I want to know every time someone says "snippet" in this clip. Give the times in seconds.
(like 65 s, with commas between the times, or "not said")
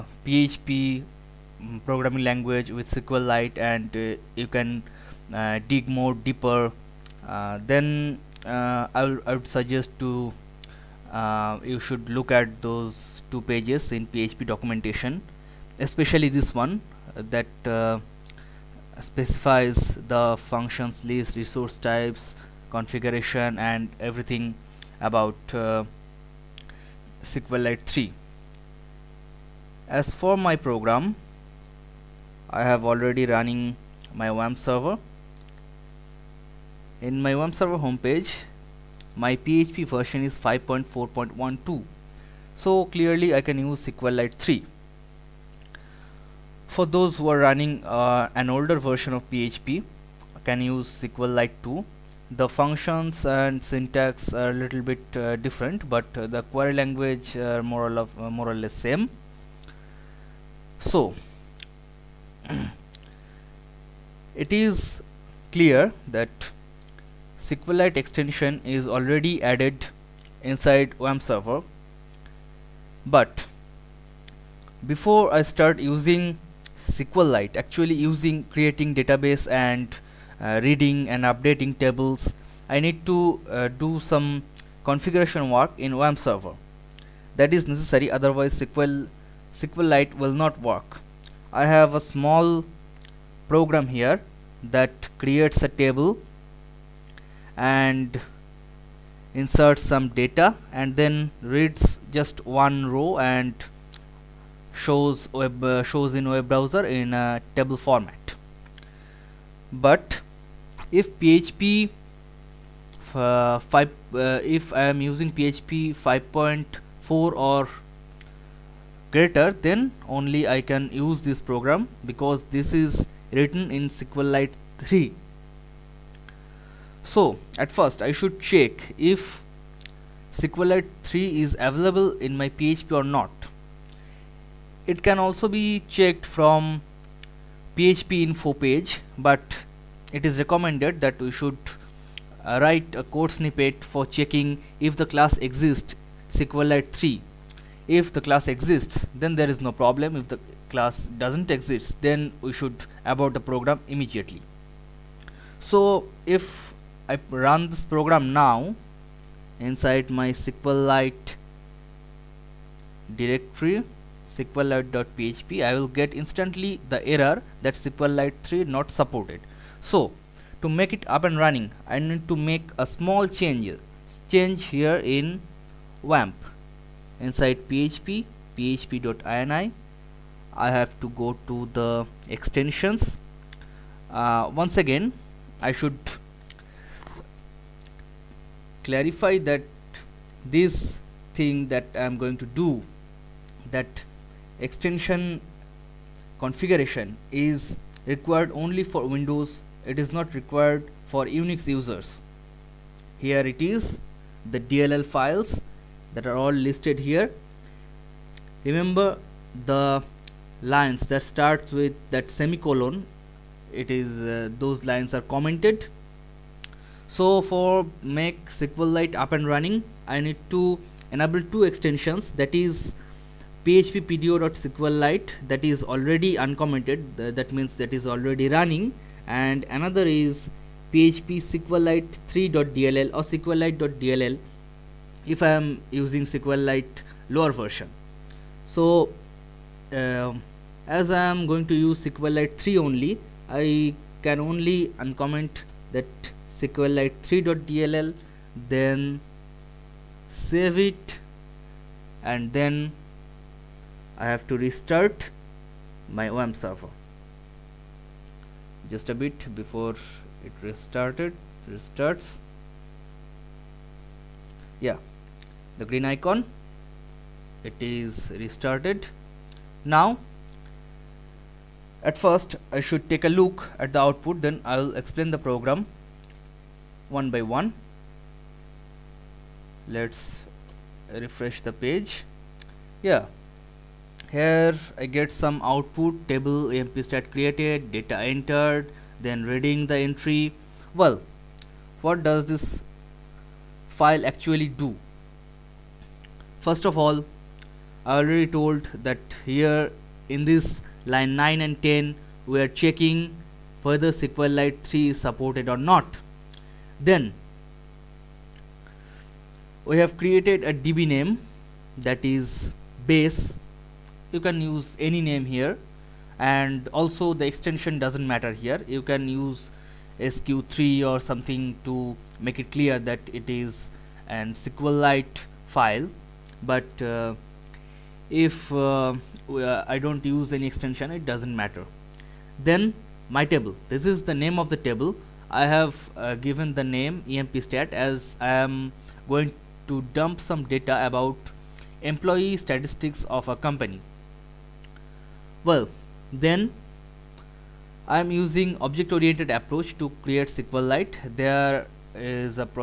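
143 s.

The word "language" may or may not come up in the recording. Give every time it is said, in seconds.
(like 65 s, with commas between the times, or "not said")
2 s, 56 s.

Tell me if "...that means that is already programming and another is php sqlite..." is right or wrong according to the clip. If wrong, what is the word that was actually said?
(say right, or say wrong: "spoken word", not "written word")
wrong: "running", not "programming".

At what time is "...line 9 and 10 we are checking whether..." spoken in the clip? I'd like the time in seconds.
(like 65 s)
301 s.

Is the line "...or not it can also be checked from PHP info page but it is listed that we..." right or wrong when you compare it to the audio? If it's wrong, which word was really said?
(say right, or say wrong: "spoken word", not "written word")
wrong: "recommended", not "listed".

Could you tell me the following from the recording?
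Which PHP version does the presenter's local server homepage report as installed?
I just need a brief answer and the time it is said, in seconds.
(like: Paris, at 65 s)
5.4.12, at 40 s.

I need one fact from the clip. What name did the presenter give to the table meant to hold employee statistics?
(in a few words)
empstat.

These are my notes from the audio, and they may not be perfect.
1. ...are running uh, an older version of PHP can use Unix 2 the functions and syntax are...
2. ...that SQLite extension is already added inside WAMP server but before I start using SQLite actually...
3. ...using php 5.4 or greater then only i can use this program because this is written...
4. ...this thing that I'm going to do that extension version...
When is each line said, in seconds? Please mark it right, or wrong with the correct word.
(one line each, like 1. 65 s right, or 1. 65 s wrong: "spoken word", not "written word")
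1. 47 s wrong: "SQLite", not "Unix"
2. 66 s right
3. 115 s right
4. 190 s wrong: "configuration", not "version".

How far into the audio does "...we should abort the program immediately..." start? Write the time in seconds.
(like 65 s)
152 s.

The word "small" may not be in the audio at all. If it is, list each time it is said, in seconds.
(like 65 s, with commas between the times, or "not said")
91 s, 172 s.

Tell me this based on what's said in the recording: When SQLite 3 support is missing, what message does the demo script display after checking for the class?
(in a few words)
SQLite 3 not supported.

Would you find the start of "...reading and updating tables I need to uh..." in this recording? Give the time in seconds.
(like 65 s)
80 s.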